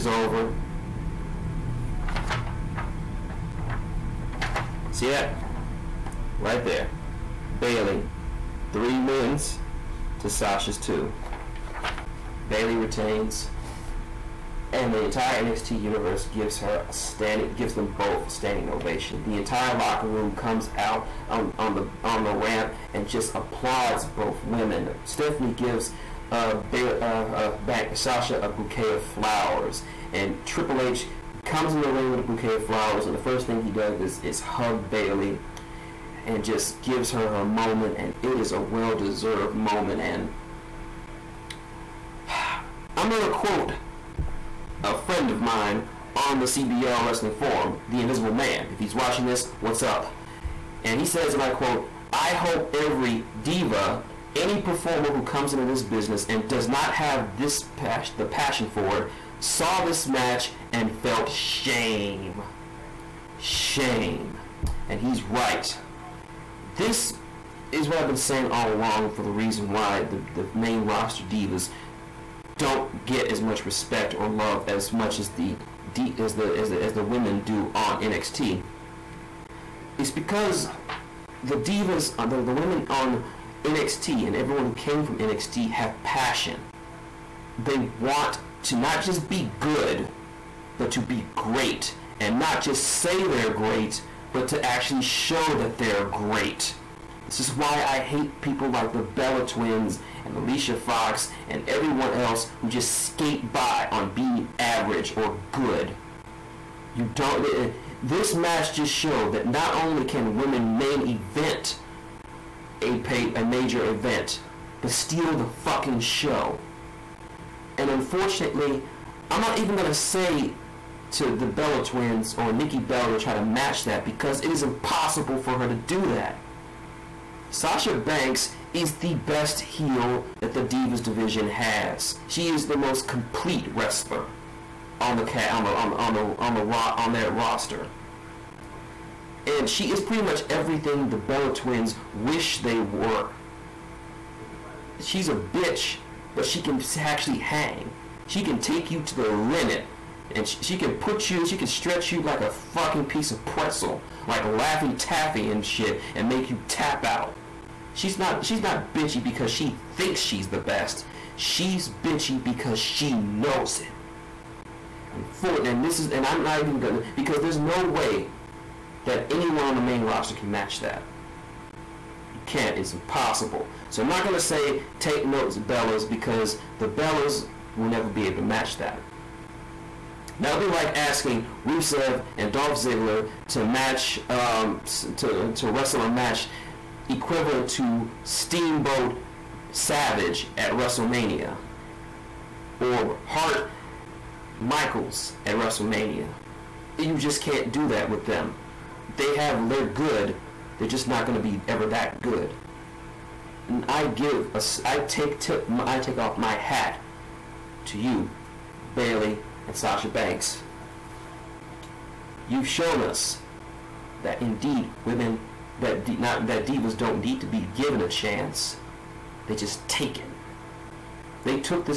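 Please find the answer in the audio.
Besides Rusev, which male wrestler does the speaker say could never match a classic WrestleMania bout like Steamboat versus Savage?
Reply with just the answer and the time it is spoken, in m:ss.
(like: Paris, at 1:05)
Dolph Ziggler, at 3:02.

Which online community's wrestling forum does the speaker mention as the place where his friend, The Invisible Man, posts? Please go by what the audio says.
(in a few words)
CBR Wrestling Forum.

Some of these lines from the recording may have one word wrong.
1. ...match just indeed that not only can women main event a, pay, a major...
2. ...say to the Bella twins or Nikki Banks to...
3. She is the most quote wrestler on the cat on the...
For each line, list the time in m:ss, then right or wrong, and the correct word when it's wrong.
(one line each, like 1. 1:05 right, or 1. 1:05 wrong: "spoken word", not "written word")
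1. 1:48 wrong: "showed", not "indeed"
2. 1:59 wrong: "Bella", not "Banks"
3. 2:12 wrong: "complete", not "quote".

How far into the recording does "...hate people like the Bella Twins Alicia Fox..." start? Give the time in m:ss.
1:37.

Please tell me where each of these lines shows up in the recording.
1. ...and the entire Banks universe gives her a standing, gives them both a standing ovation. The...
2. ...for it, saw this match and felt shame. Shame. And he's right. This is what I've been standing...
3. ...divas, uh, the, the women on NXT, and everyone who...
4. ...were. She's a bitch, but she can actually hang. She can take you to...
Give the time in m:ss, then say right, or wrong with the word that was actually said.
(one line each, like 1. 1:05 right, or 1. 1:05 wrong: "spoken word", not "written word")
1. 0:14 wrong: "NXT", not "Banks"
2. 0:58 wrong: "saying", not "standing"
3. 1:21 right
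4. 2:22 right.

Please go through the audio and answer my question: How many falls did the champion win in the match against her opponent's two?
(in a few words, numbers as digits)
3.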